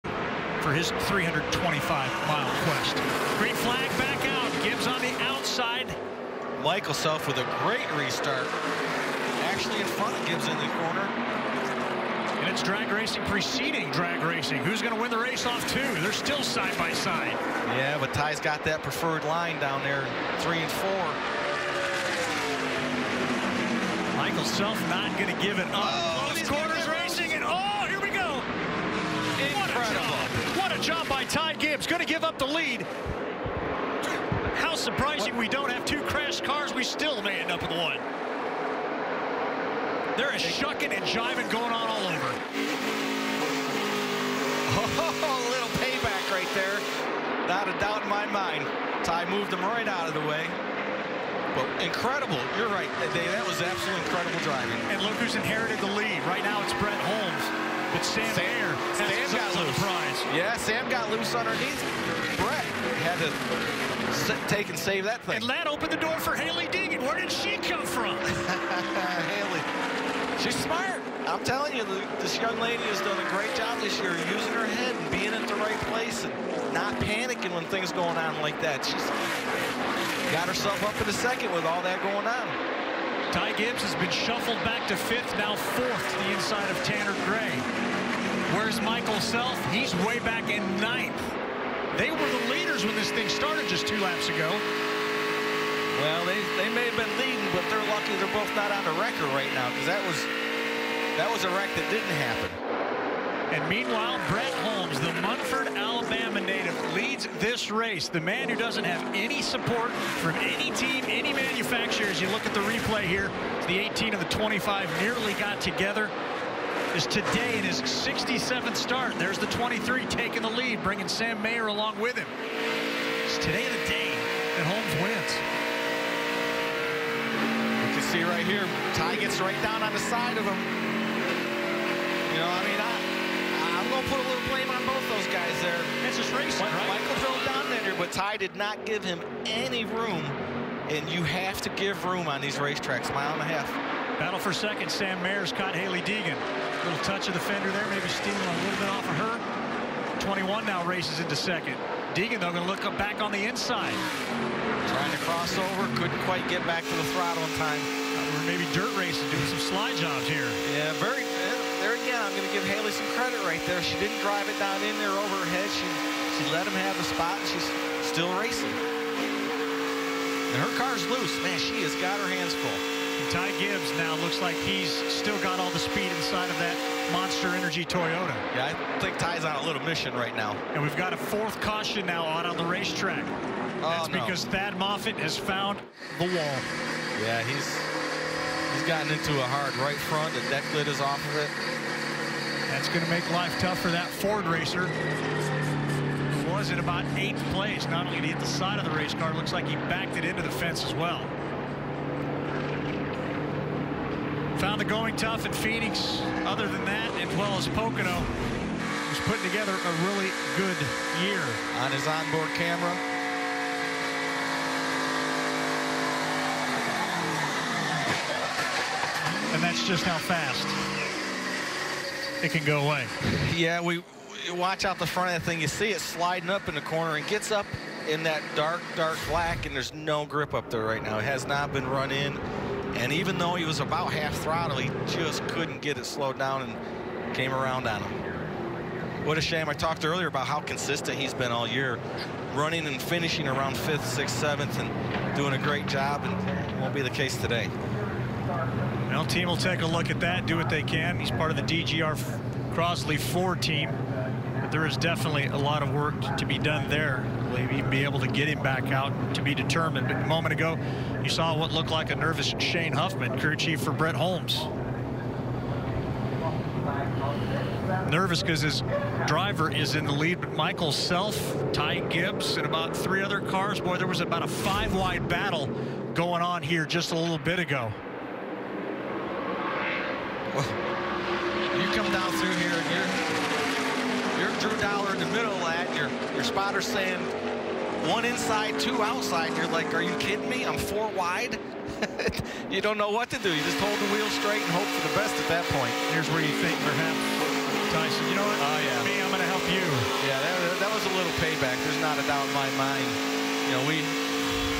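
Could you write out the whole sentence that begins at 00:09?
Actually in front of Gibbs in the corner.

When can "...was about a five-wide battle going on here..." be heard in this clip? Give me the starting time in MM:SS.
04:34.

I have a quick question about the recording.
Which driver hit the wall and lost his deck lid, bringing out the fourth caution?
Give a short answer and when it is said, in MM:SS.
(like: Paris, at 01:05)
Thad Moffitt, at 03:04.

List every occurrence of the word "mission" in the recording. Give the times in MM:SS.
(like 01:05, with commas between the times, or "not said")
02:59.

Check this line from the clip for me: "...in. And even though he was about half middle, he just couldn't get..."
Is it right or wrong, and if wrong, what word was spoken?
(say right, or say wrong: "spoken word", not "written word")
wrong: "throttle", not "middle".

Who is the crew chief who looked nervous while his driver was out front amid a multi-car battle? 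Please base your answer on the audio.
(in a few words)
Shane Huffman.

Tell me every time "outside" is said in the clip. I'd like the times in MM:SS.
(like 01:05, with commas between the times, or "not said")
00:05, 04:49.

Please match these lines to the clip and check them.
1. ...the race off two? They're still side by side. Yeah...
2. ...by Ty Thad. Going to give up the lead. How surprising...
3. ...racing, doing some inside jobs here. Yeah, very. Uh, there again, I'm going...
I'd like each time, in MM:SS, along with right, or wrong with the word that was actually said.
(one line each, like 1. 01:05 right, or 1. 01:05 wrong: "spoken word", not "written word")
1. 00:15 right
2. 00:31 wrong: "Gibbs", not "Thad"
3. 02:39 wrong: "slide", not "inside".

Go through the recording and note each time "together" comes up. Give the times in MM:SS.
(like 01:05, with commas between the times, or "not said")
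01:55, 03:29.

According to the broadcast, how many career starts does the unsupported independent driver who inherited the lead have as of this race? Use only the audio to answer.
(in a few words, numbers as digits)
67.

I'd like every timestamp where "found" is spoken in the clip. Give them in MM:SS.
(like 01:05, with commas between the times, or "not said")
03:05, 03:24.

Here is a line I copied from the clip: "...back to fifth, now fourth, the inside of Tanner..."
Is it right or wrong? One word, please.
right.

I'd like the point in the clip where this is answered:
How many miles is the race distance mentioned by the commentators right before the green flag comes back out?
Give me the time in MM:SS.
00:01.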